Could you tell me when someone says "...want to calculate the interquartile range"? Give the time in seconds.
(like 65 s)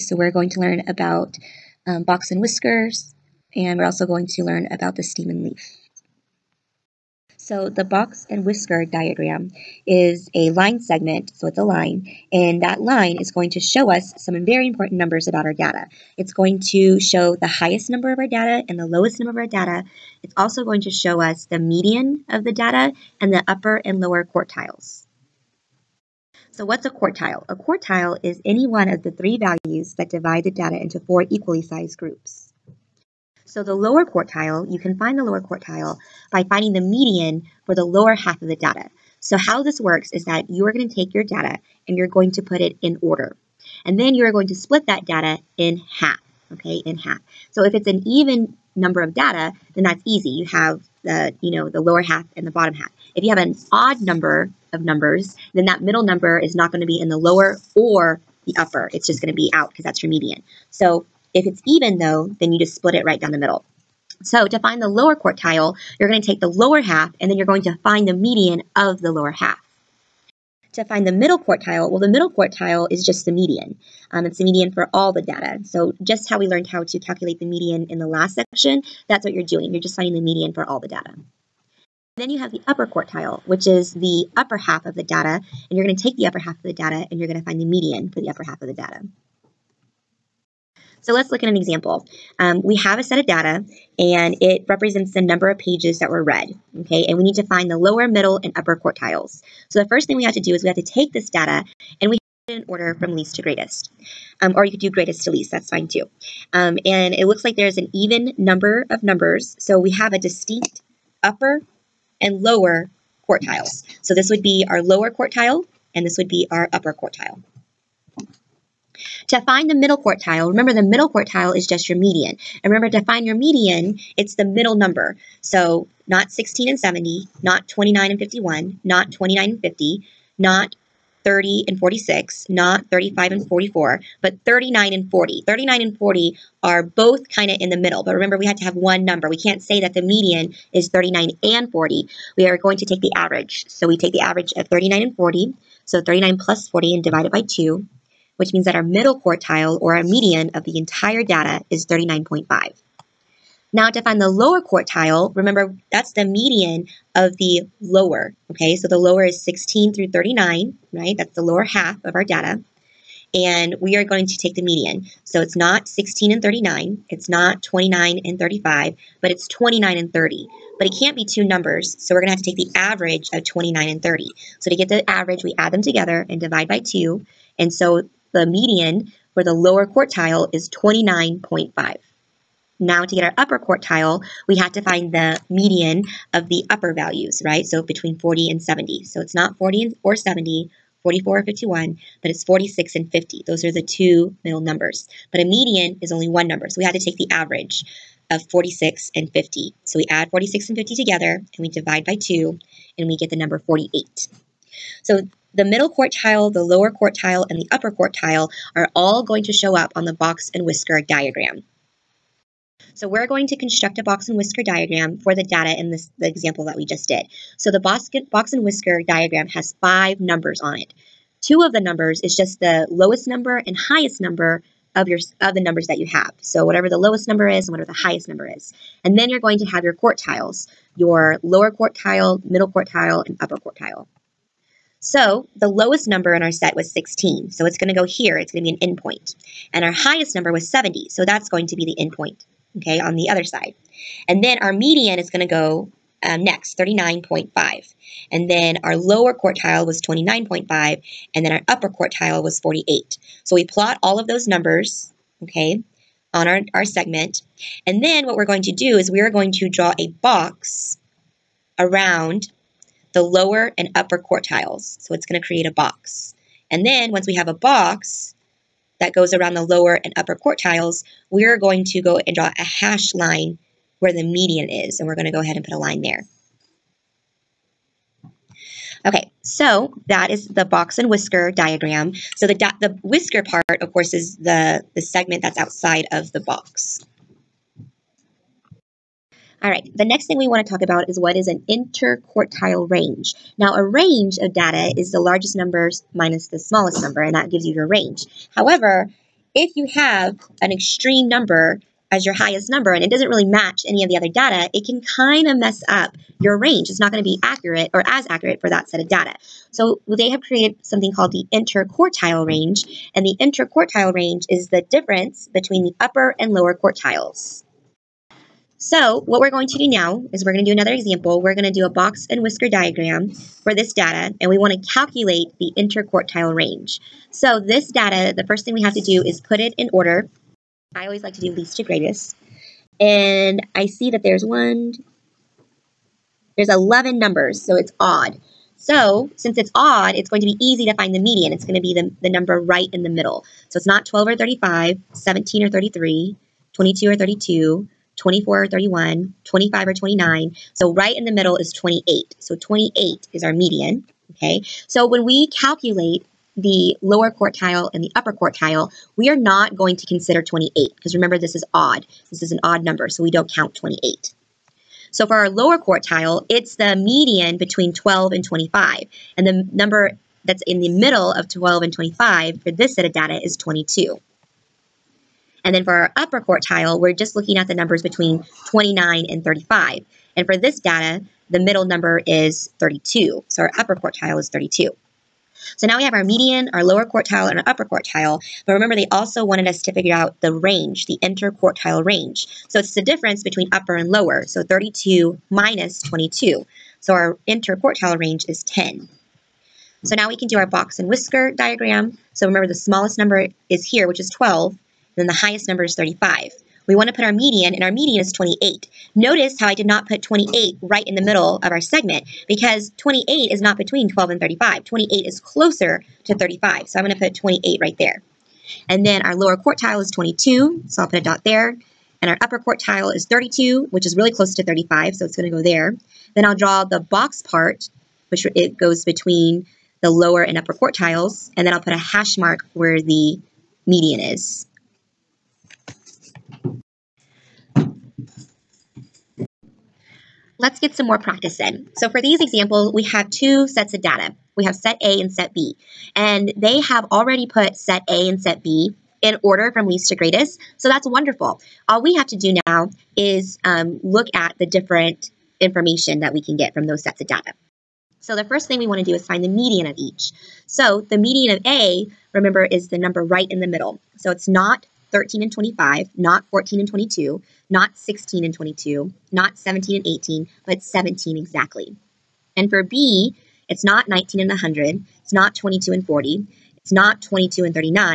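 324 s.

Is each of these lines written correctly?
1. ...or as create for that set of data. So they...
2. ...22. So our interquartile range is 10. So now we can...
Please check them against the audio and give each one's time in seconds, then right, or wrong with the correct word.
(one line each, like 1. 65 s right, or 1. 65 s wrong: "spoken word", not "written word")
1. 307 s wrong: "accurate", not "create"
2. 396 s right.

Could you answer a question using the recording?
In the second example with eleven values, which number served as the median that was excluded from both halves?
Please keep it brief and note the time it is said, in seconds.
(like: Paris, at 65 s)
28, at 350 s.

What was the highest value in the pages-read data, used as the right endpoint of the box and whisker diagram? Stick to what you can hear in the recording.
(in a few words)
70.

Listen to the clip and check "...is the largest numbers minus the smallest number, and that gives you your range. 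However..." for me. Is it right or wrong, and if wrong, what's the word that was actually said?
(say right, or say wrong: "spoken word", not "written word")
right.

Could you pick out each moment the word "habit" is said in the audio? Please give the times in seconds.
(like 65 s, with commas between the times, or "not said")
not said.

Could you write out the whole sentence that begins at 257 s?
And then what we're going to do is we're going to draw a box around the lower and upper quartiles.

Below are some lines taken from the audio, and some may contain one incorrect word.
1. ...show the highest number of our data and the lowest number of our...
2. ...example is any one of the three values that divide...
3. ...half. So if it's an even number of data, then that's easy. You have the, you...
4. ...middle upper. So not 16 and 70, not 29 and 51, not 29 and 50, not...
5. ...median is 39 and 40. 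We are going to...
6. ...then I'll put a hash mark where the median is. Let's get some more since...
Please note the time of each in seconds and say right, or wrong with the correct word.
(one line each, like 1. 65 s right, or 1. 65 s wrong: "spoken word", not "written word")
1. 16 s right
2. 27 s wrong: "quartile", not "example"
3. 46 s right
4. 124 s wrong: "number", not "upper"
5. 140 s right
6. 431 s wrong: "practice", not "since".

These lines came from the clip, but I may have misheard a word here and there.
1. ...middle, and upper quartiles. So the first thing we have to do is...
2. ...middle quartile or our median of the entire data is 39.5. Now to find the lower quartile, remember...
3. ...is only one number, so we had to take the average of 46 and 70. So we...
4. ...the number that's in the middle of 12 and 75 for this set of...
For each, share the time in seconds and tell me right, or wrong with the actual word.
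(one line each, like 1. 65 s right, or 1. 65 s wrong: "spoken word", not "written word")
1. 98 s right
2. 148 s right
3. 196 s wrong: "50", not "70"
4. 369 s wrong: "25", not "75".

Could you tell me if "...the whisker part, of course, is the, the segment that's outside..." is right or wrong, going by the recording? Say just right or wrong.
right.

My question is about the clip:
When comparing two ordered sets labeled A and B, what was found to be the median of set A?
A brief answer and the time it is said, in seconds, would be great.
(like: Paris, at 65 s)
17, at 470 s.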